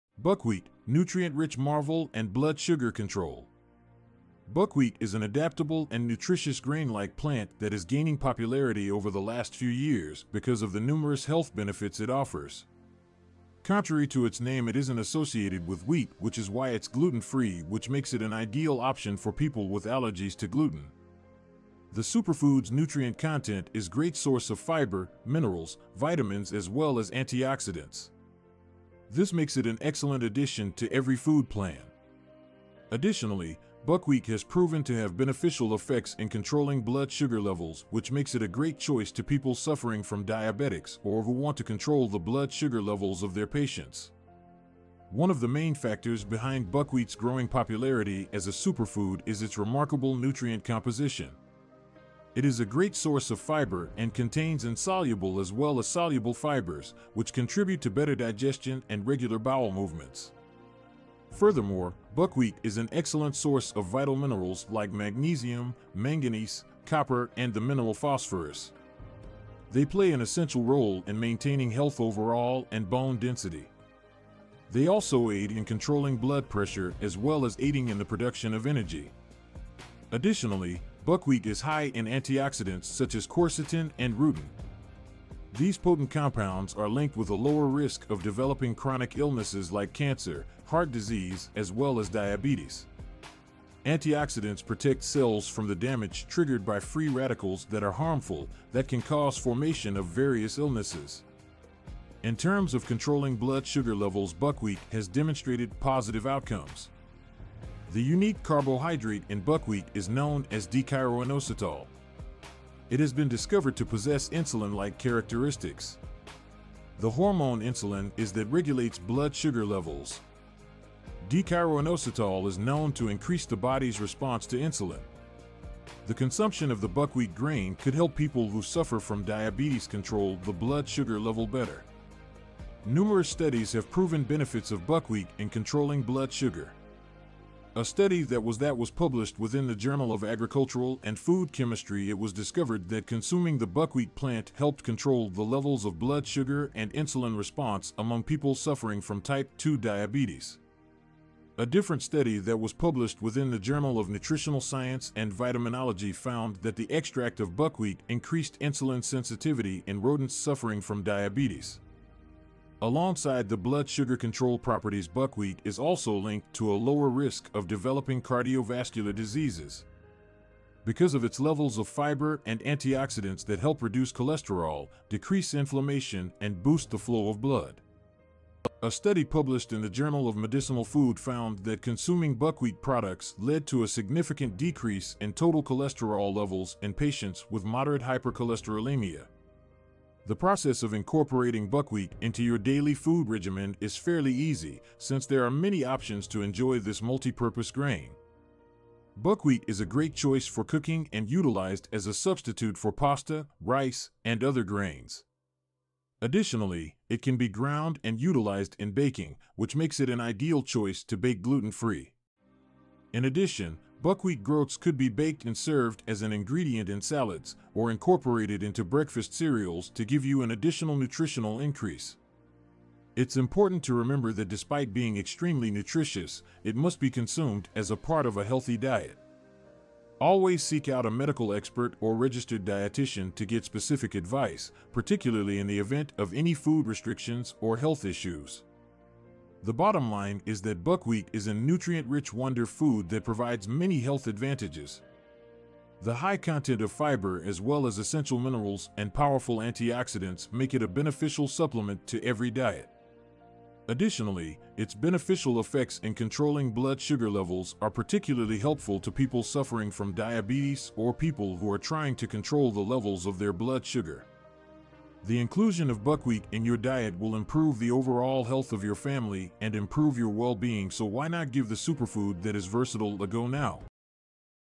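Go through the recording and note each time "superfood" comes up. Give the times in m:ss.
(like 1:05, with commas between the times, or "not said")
0:22, 0:48, 4:31.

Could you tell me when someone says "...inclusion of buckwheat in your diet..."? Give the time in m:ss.
4:25.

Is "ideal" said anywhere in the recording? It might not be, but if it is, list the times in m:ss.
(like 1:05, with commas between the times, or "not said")
0:18, 3:30.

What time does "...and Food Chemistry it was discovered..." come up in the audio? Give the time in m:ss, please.
2:21.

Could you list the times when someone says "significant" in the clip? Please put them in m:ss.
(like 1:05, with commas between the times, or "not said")
3:03.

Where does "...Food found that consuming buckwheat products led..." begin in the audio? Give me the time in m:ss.
3:00.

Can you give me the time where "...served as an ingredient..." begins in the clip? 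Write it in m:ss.
3:35.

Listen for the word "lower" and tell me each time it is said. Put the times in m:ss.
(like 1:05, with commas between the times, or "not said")
1:27, 2:46.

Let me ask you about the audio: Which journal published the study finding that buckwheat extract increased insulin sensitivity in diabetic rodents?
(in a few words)
Journal of Nutritional Science and Vitaminology.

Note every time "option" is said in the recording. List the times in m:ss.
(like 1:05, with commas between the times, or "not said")
0:18, 3:15.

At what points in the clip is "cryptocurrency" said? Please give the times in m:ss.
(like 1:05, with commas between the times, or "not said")
not said.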